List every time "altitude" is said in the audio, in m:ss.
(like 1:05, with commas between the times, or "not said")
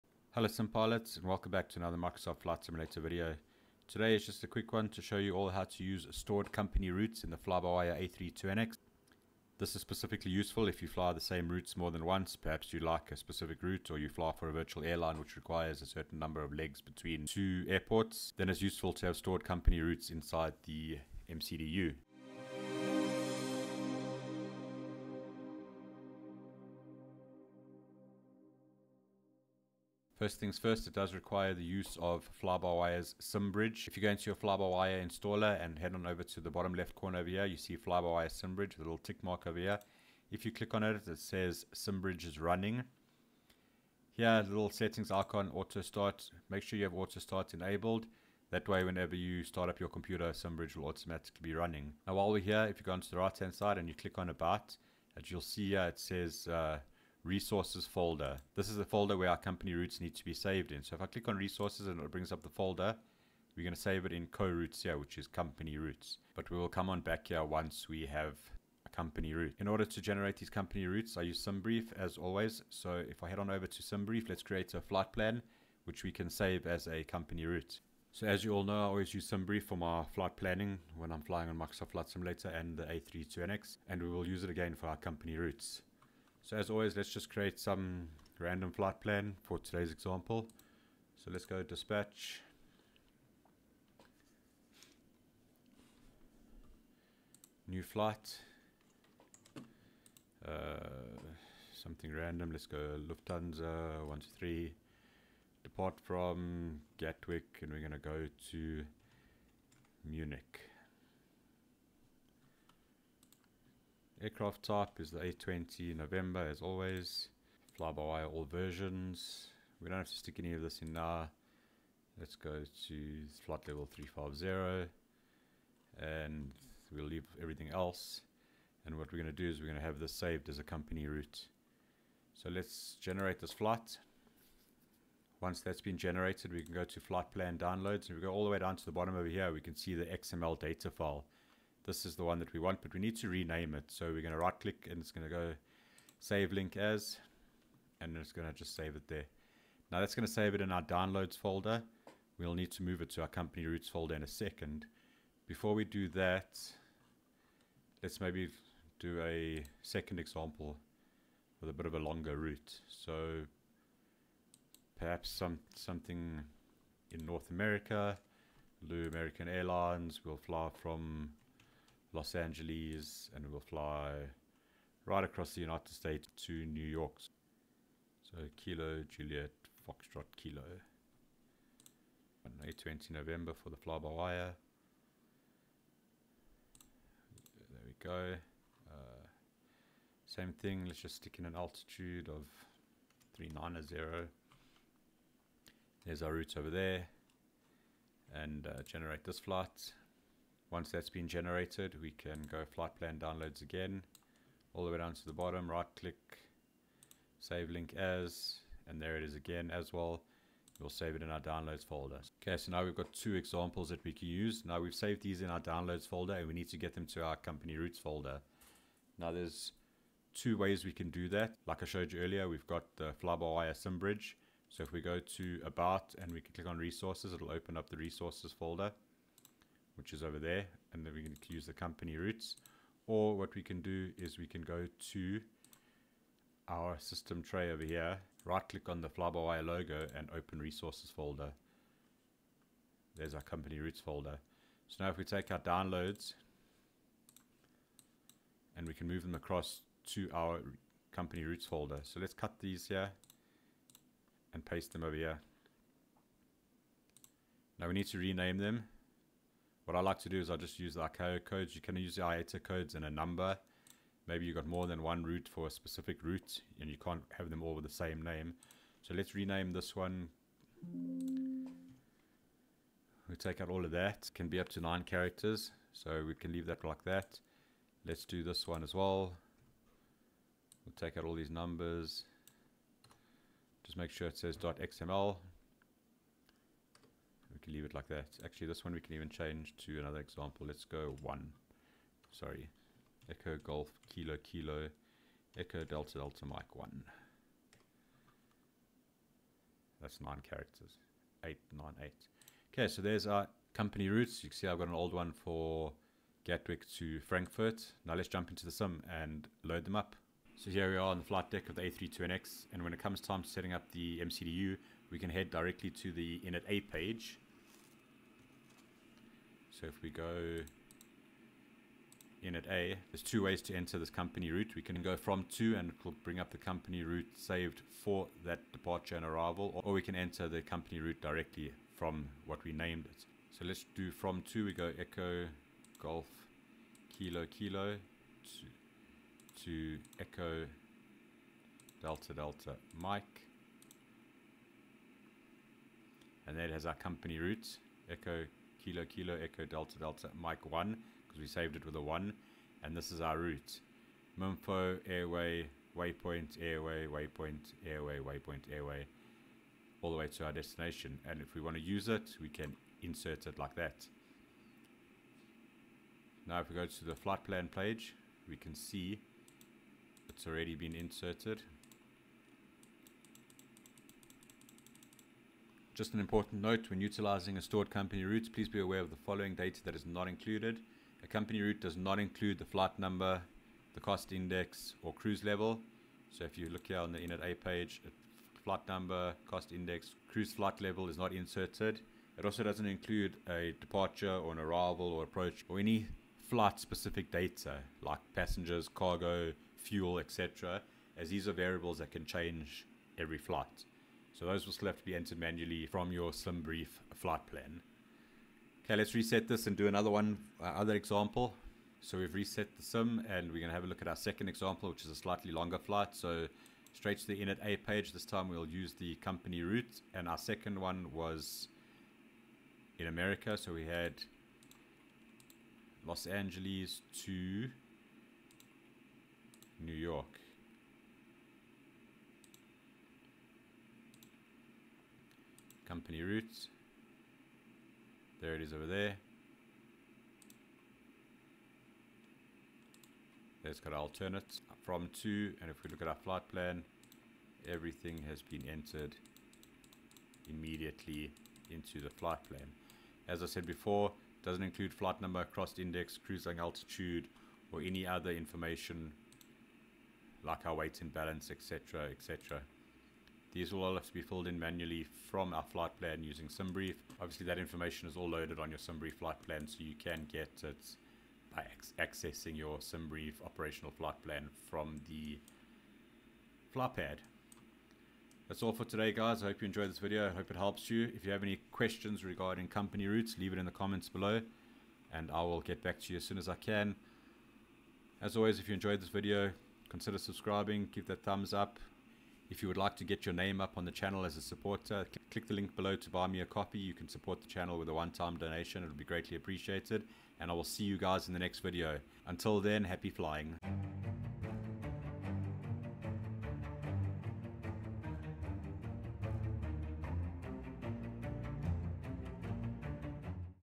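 3:11, 7:36.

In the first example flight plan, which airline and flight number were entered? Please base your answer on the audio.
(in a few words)
Lufthansa 123.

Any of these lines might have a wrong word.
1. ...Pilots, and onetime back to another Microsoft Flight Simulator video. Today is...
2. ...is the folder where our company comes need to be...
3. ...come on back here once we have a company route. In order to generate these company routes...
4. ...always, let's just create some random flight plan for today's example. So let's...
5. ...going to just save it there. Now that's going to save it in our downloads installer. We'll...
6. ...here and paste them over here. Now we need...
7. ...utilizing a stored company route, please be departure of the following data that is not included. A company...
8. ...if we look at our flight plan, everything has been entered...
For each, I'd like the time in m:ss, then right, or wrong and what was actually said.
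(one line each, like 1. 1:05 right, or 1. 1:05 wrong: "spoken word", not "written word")
1. 0:00 wrong: "welcome", not "onetime"
2. 0:58 wrong: "routes", not "comes"
3. 1:06 right
4. 1:26 right
5. 2:28 wrong: "folder", not "installer"
6. 4:12 right
7. 6:17 wrong: "aware", not "departure"
8. 7:25 right.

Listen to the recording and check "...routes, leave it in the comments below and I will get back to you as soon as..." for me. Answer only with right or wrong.
right.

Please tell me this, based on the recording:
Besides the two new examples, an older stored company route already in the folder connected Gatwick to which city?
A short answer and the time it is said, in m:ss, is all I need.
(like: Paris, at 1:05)
Frankfurt, at 5:07.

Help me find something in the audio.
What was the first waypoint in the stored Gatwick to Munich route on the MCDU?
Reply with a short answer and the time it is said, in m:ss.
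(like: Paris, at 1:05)
Mumfo, at 5:54.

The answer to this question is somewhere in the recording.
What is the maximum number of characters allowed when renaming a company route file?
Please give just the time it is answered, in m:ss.
4:34.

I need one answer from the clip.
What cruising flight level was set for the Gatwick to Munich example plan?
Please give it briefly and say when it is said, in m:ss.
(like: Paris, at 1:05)
Flight level 350, at 2:03.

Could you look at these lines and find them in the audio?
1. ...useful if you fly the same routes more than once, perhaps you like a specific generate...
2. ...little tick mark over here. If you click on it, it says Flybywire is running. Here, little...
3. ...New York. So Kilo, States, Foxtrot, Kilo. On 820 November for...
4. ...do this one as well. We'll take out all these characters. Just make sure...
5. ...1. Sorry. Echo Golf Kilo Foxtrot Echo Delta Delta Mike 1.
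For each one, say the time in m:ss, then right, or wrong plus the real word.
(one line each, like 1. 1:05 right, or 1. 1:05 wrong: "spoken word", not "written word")
1. 0:10 wrong: "route", not "generate"
2. 0:38 wrong: "SimBridge", not "Flybywire"
3. 2:56 wrong: "Juliet", not "States"
4. 4:38 wrong: "numbers", not "characters"
5. 4:51 wrong: "Kilo", not "Foxtrot".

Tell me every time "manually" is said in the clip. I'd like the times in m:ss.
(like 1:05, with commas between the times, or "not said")
6:45, 7:44.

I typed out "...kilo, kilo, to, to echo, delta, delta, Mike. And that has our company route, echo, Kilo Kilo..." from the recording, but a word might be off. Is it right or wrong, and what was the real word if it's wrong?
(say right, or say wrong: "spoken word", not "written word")
right.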